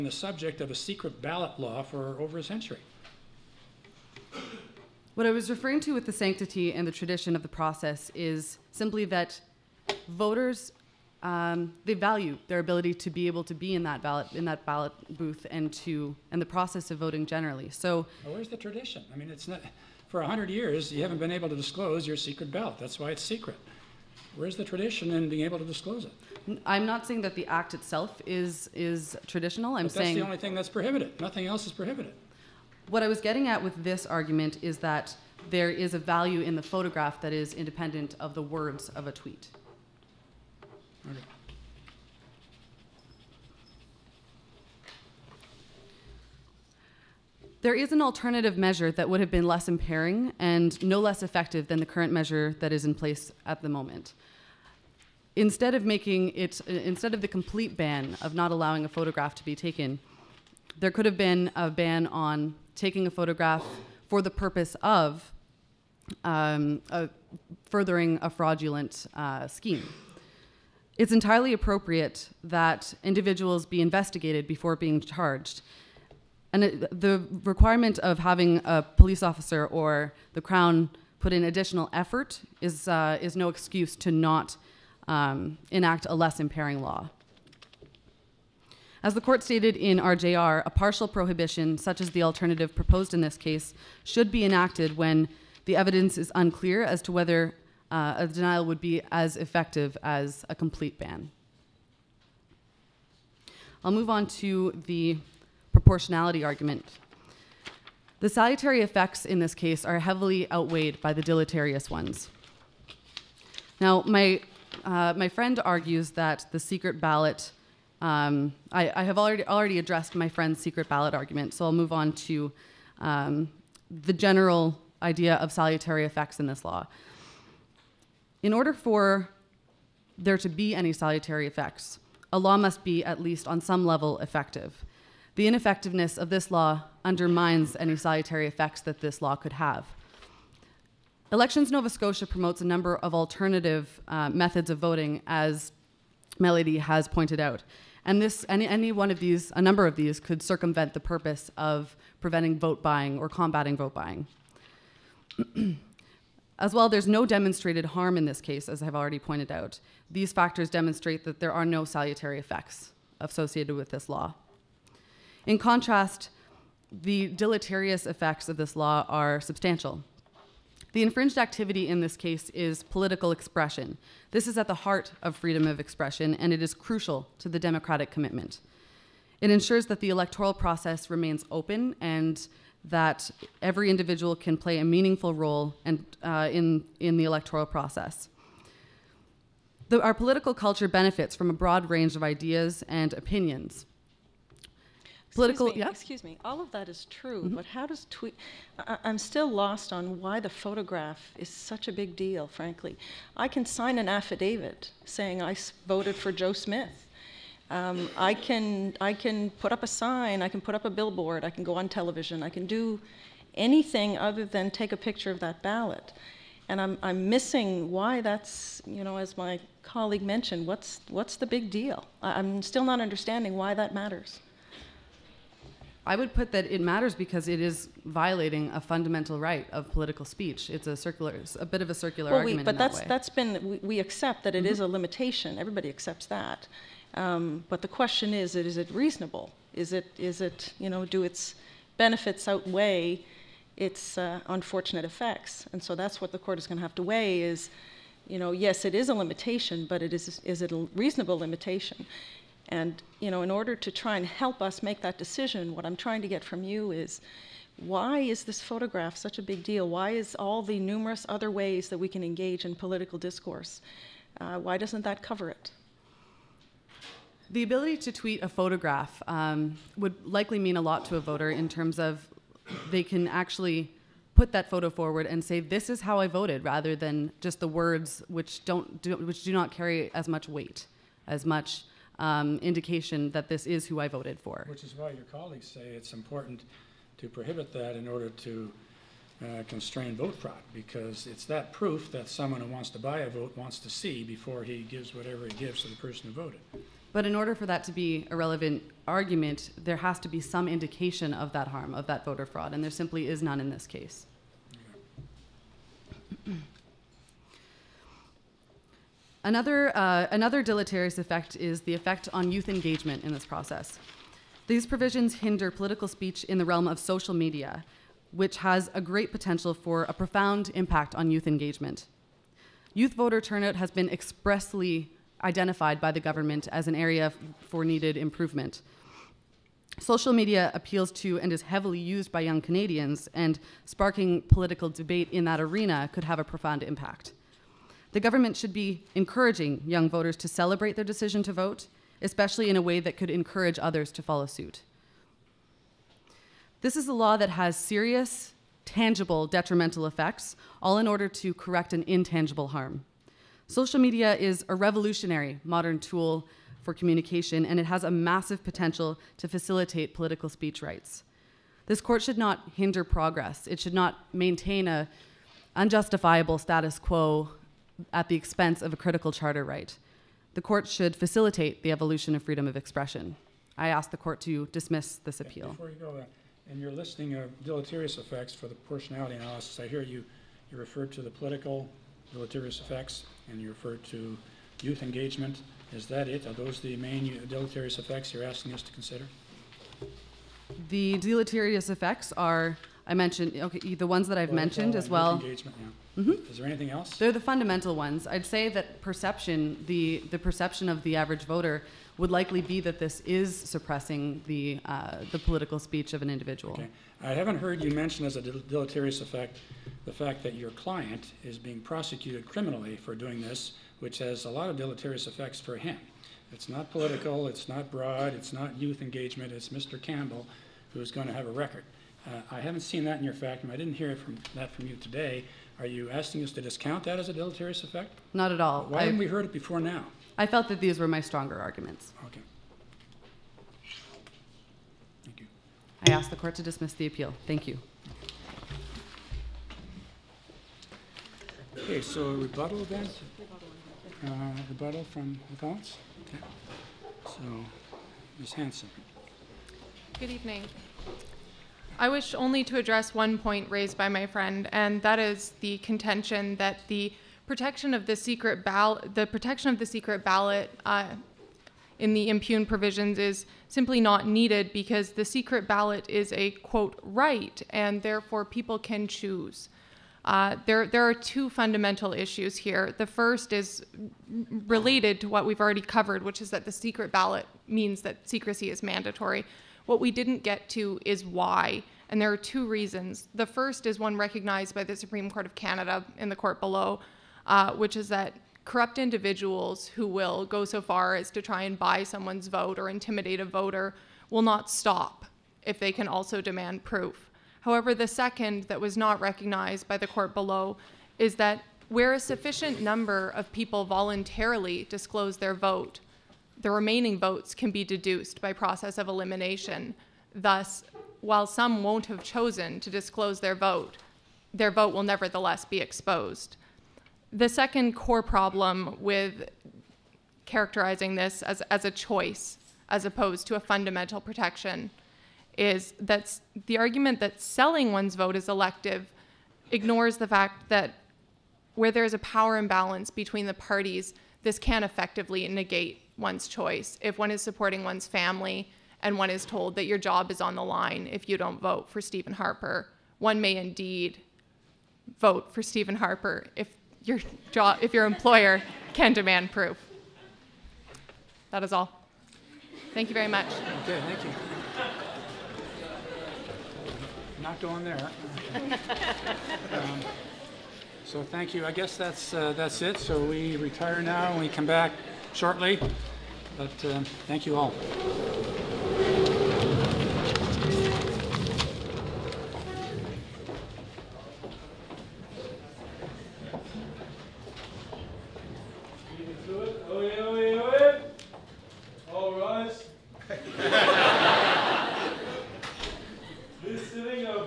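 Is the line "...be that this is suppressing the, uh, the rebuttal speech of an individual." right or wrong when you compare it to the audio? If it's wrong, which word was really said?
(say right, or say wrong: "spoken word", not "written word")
wrong: "political", not "rebuttal".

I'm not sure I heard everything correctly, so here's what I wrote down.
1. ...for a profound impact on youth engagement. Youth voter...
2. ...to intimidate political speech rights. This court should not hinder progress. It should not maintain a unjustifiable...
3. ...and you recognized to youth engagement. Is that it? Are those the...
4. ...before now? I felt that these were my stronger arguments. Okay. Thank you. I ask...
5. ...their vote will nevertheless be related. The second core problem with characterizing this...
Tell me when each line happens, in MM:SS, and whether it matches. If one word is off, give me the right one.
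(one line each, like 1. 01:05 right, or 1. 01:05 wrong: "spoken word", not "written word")
1. 05:19 right
2. 05:59 wrong: "facilitate", not "intimidate"
3. 06:23 wrong: "referred", not "recognized"
4. 07:09 right
5. 08:34 wrong: "exposed", not "related".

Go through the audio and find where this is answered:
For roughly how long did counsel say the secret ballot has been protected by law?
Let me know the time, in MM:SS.
00:02.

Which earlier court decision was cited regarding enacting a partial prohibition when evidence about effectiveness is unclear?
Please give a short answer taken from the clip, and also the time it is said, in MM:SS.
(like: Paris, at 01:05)
RJR, at 01:29.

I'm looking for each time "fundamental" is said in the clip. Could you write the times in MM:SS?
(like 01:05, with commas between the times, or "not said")
03:48, 06:37, 07:51, 08:43.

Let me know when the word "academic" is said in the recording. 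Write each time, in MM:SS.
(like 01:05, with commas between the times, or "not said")
not said.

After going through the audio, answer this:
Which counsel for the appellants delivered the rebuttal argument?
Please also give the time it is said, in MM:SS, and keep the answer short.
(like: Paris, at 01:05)
Ms. Hansen, at 07:28.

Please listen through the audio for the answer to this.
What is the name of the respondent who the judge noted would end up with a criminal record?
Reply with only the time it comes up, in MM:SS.
06:59.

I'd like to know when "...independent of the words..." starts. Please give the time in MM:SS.
00:37.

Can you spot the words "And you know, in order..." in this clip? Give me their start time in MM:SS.
04:12.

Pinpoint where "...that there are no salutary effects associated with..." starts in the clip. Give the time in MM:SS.
02:41.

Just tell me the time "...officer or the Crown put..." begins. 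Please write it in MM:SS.
01:19.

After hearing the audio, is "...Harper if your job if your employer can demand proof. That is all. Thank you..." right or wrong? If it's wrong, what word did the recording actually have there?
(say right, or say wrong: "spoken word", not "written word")
right.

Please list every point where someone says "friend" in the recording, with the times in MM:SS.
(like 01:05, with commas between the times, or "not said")
01:55, 02:00, 07:34.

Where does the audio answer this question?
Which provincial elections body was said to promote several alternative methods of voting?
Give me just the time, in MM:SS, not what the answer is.
02:21.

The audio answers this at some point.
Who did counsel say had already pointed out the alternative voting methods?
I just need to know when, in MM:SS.
02:26.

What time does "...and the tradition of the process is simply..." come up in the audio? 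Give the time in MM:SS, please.
00:06.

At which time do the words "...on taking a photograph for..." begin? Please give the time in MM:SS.
01:02.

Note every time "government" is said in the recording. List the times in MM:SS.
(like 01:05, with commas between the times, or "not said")
05:26, 05:38.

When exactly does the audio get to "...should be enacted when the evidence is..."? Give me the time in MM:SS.
01:34.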